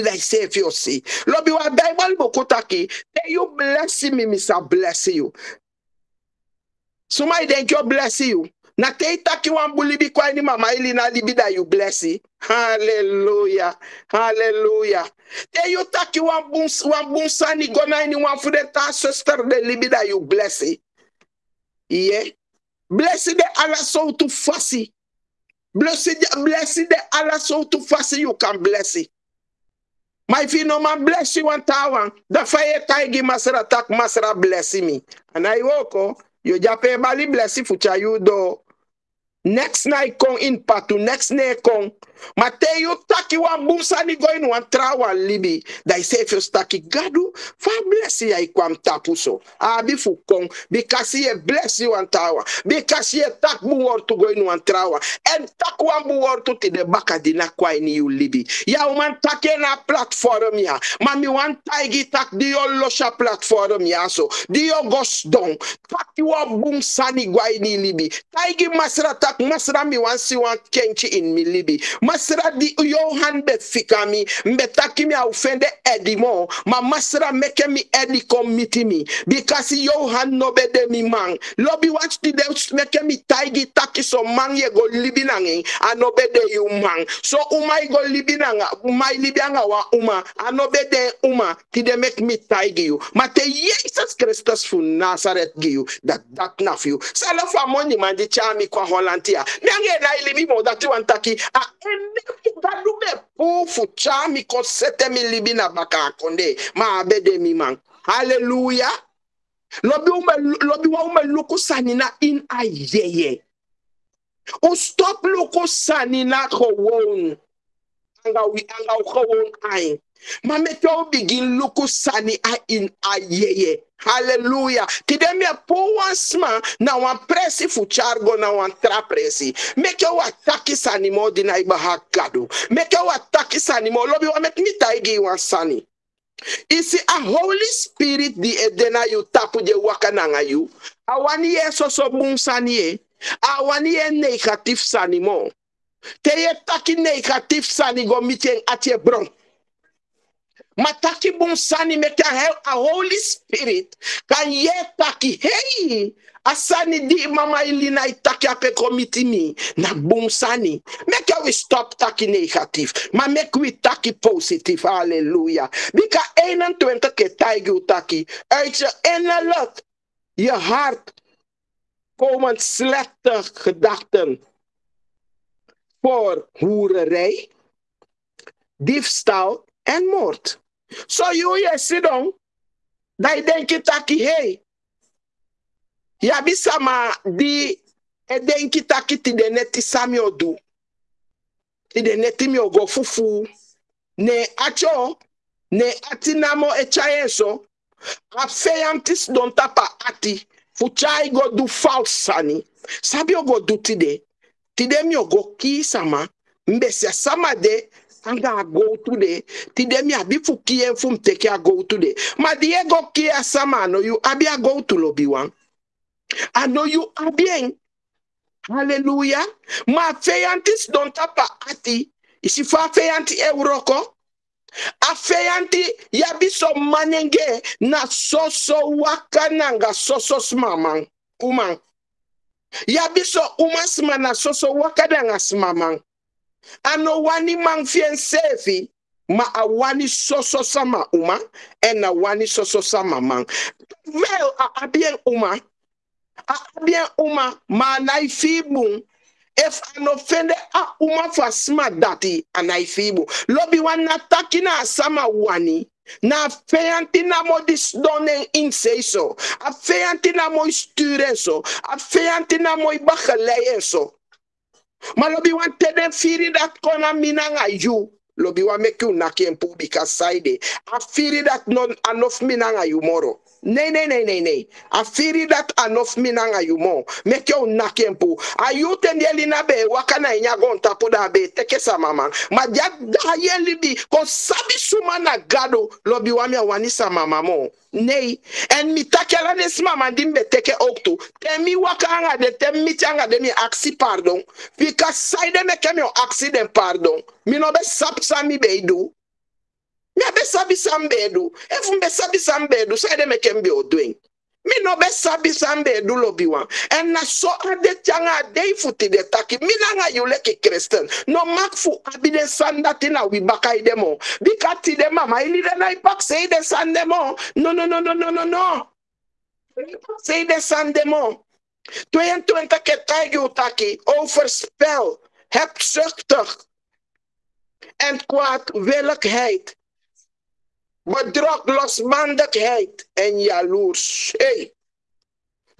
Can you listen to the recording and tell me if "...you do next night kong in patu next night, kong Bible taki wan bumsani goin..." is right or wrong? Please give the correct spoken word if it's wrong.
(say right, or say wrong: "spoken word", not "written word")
wrong: "Mateju", not "Bible".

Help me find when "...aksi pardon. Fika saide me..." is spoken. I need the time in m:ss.
4:53.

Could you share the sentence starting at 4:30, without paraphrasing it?
A firi dat non anof minang a you moro.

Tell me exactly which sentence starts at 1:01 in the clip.
Mami wan taigi tak di losha platform ya so.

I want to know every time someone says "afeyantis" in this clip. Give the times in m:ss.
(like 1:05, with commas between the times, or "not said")
3:18, 3:45.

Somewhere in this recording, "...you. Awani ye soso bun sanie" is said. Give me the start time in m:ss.
2:20.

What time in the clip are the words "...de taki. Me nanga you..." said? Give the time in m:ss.
5:09.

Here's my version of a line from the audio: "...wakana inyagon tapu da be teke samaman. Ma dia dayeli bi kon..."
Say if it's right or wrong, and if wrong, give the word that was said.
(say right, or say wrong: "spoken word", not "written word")
right.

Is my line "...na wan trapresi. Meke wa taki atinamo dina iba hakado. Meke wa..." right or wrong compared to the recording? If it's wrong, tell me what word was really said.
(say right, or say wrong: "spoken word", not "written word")
wrong: "sanimo", not "atinamo".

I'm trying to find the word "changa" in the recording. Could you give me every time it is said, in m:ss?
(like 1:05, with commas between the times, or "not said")
5:08.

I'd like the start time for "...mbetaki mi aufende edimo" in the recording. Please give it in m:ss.
1:14.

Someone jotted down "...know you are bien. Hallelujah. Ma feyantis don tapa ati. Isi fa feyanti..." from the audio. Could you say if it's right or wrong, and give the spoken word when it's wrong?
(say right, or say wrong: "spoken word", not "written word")
right.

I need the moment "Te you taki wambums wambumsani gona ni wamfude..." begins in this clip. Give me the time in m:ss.
0:15.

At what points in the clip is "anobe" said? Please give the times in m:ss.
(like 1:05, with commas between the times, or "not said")
1:25, 1:30.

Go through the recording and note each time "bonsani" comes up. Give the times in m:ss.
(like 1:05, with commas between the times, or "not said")
2:31, 2:39.